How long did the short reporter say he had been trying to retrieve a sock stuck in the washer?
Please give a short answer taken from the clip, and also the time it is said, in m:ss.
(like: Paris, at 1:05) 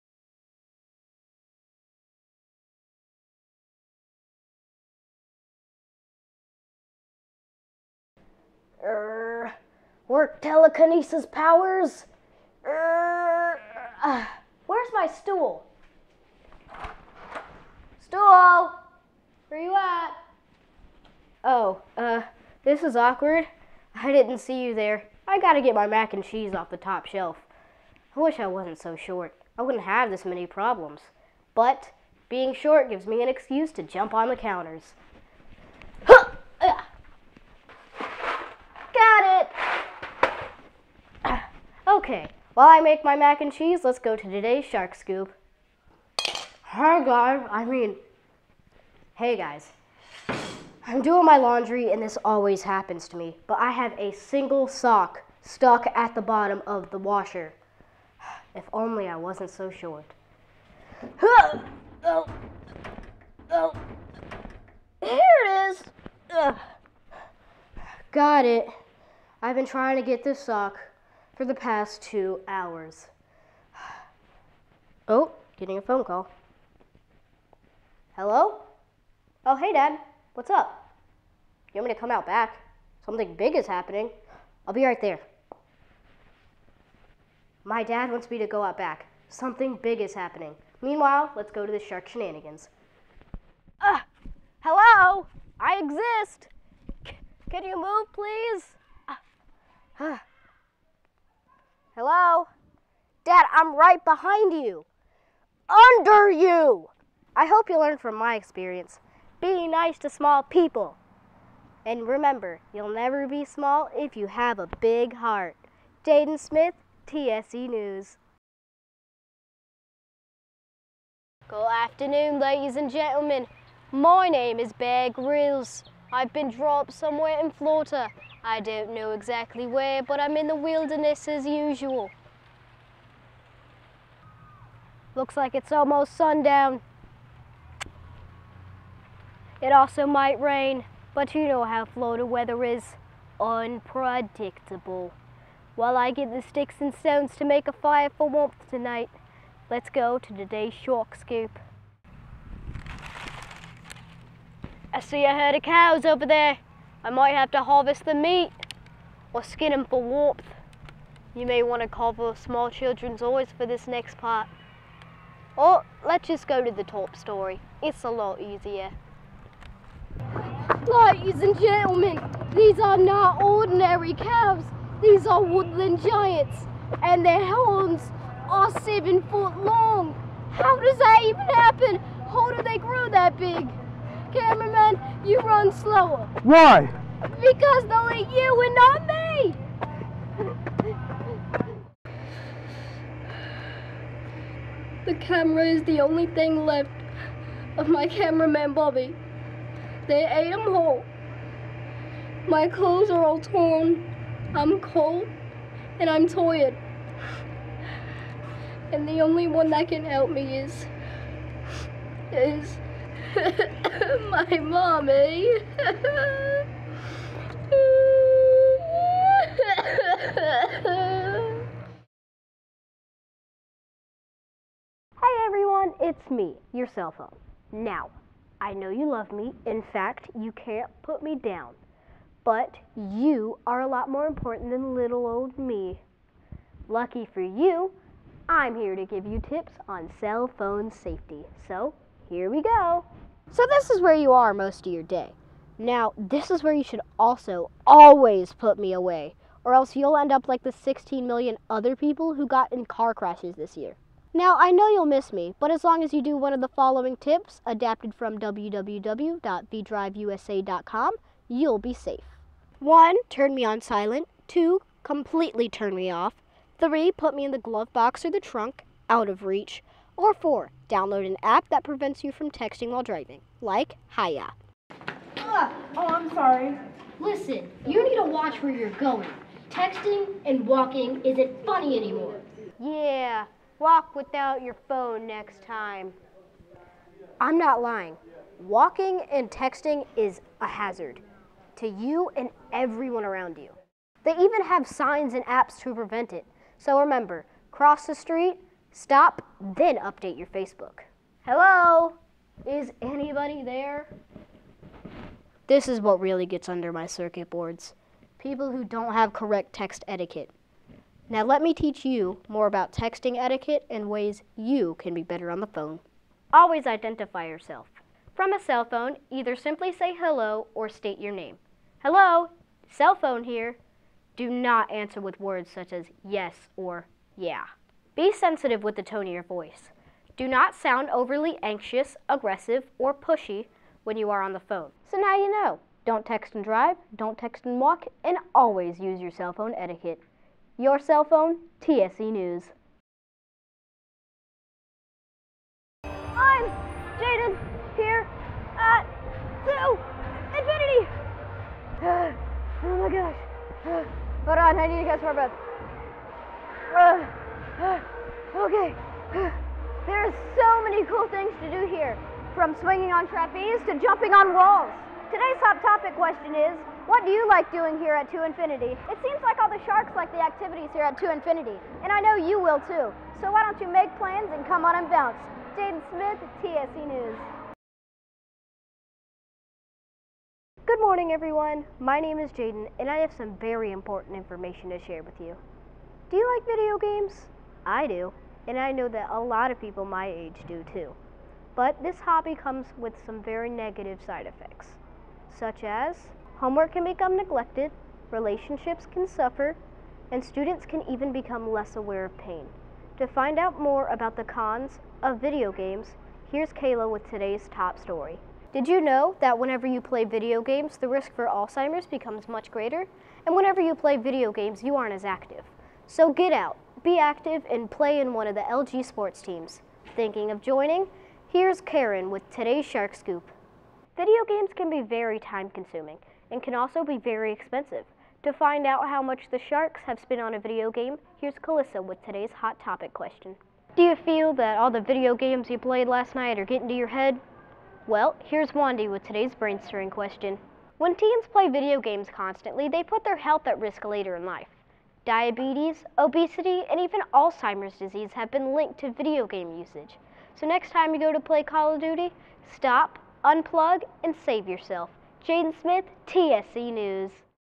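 2 hours, at 1:12.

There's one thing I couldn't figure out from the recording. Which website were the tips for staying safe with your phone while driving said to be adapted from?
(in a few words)
www.vdriveusa.com.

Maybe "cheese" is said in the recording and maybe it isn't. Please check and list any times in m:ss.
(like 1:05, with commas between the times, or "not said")
0:26, 0:43.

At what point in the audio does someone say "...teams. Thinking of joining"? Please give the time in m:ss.
6:59.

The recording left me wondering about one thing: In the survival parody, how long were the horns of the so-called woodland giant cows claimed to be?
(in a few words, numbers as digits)
7 feet.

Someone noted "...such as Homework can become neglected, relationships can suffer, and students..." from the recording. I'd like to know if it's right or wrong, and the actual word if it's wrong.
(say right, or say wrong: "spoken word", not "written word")
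right.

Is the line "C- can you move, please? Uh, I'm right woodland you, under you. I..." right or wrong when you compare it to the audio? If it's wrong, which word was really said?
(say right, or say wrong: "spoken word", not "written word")
wrong: "behind", not "woodland".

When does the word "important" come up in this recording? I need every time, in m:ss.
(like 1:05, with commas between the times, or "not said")
3:54, 6:23.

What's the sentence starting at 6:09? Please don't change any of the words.
It seems like all the sharks like the activities here at 2 Infinity, and I know you will too.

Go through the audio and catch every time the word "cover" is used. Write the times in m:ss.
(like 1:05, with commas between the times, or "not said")
2:41.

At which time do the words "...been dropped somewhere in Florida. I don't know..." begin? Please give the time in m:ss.
2:06.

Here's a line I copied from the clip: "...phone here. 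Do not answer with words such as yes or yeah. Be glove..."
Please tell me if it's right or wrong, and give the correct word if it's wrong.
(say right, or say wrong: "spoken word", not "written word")
wrong: "sensitive", not "glove".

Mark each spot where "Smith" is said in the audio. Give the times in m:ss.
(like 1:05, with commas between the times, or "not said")
1:56, 6:16, 7:35.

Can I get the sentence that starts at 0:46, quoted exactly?
Hi guys, I mean, hey guys.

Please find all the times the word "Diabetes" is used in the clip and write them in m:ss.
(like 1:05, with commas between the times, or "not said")
7:25.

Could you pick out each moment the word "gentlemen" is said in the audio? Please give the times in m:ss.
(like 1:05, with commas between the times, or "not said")
2:02, 2:51.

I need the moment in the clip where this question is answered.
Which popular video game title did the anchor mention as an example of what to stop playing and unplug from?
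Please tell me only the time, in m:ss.
7:31.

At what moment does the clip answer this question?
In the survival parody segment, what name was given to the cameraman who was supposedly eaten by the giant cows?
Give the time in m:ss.
3:18.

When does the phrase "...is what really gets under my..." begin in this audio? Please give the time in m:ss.
5:05.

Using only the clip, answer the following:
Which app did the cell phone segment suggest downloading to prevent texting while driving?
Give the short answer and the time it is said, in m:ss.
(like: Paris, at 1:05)
Haya, at 4:34.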